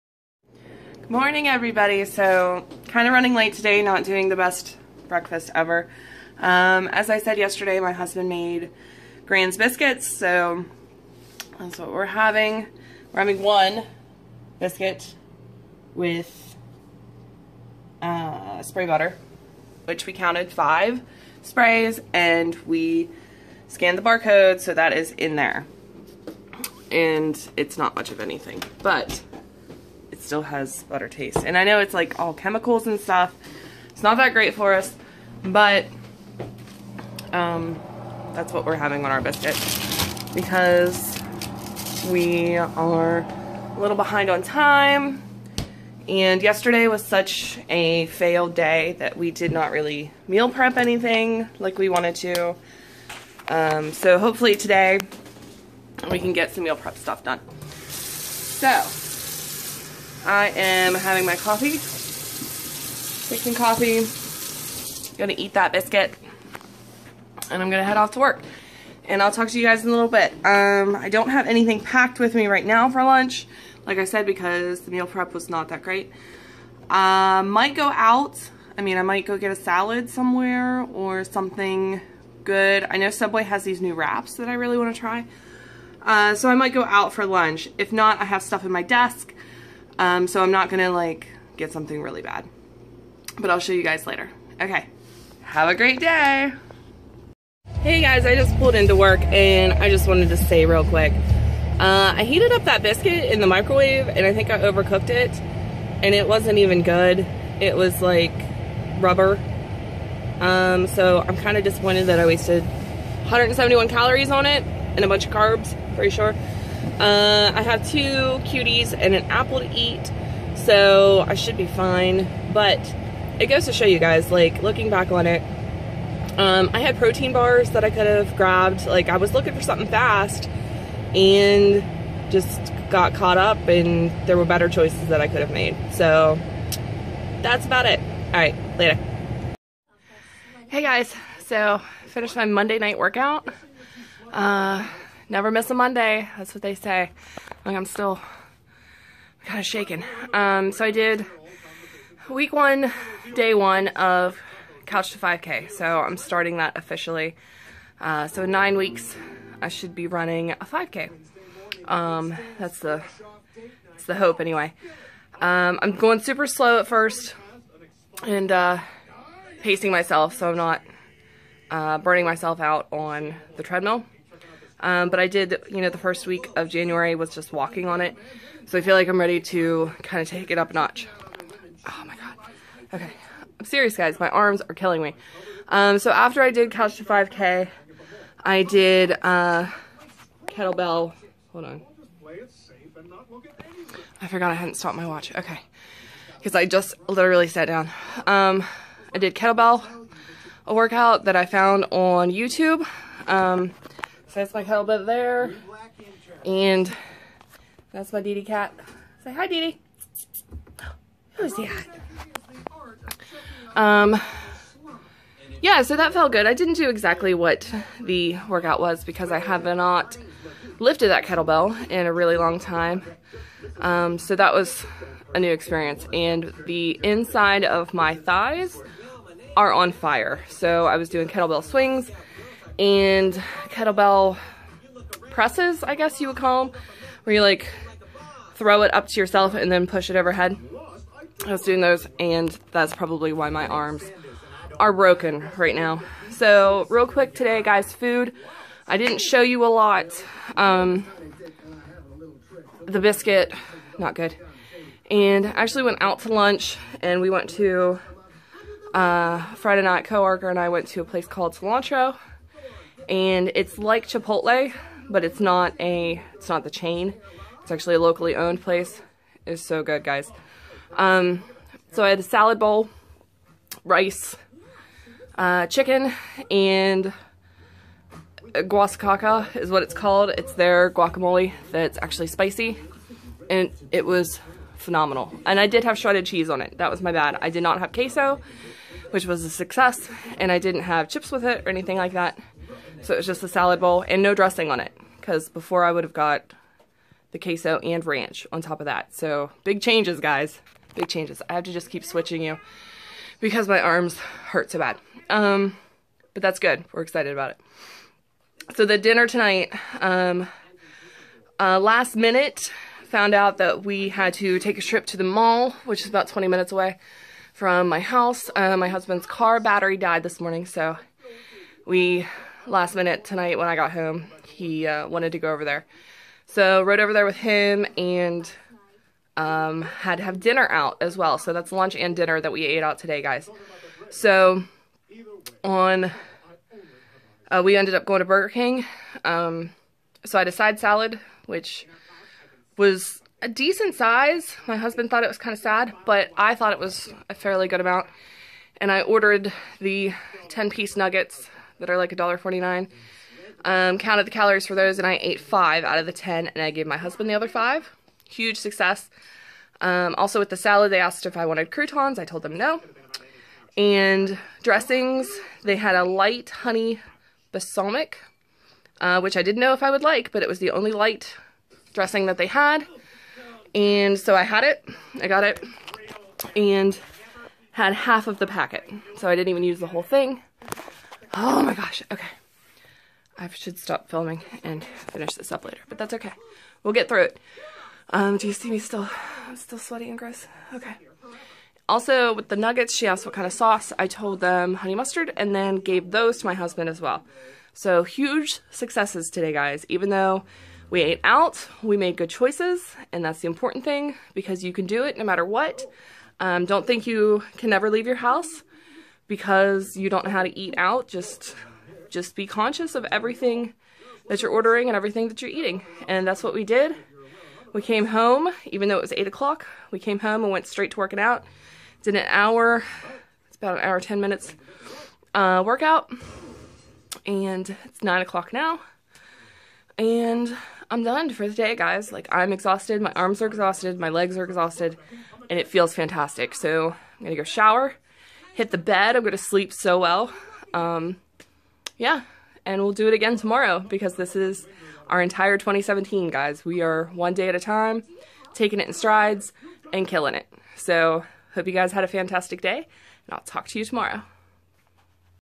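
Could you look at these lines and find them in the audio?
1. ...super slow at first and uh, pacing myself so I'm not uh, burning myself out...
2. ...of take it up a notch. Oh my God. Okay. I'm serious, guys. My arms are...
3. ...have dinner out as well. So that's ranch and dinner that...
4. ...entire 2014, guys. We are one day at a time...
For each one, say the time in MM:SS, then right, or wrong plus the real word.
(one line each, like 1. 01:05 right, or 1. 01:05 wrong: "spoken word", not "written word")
1. 02:46 right
2. 03:00 right
3. 05:30 wrong: "lunch", not "ranch"
4. 07:25 wrong: "2017", not "2014".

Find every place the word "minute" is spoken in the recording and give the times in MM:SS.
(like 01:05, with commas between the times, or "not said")
05:12, 05:16, 05:22, 07:04.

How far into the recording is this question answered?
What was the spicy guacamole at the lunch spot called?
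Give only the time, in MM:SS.
04:38.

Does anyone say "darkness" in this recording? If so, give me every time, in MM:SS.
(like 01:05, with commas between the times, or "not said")
not said.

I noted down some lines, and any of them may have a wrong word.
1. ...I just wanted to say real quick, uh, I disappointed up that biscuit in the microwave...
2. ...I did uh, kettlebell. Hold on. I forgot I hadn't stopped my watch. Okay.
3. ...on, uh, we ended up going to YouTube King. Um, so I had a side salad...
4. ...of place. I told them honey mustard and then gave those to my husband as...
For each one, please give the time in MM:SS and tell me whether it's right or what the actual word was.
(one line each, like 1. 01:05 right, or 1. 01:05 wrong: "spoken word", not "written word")
1. 01:39 wrong: "heated", not "disappointed"
2. 03:08 right
3. 05:35 wrong: "Burger", not "YouTube"
4. 06:33 wrong: "sauce", not "place".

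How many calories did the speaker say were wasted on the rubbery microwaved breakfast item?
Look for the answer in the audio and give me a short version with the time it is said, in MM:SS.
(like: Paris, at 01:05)
171, at 01:52.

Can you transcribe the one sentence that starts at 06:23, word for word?
I should stop filming and finish this up later, but that's okay.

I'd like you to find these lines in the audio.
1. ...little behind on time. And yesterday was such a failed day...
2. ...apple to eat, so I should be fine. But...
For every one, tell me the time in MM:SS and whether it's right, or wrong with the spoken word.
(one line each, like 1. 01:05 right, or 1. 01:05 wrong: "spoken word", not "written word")
1. 00:43 right
2. 01:59 right.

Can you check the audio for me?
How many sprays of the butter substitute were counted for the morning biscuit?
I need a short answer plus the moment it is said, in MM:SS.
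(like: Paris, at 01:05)
5, at 00:20.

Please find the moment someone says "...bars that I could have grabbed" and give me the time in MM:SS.
02:07.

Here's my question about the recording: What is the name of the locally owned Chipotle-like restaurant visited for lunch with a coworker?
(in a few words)
Cilantro.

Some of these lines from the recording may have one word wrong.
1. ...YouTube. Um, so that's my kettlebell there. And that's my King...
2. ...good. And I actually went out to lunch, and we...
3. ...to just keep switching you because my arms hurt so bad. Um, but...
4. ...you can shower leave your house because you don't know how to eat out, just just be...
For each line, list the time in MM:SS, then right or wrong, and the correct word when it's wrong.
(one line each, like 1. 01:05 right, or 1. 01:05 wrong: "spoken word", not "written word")
1. 03:22 wrong: "Didi", not "King"
2. 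04:14 right
3. 05:01 right
4. 06:47 wrong: "never", not "shower".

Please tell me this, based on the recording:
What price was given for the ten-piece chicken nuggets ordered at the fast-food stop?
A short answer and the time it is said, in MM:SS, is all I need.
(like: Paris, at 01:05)
$1.49, at 05:52.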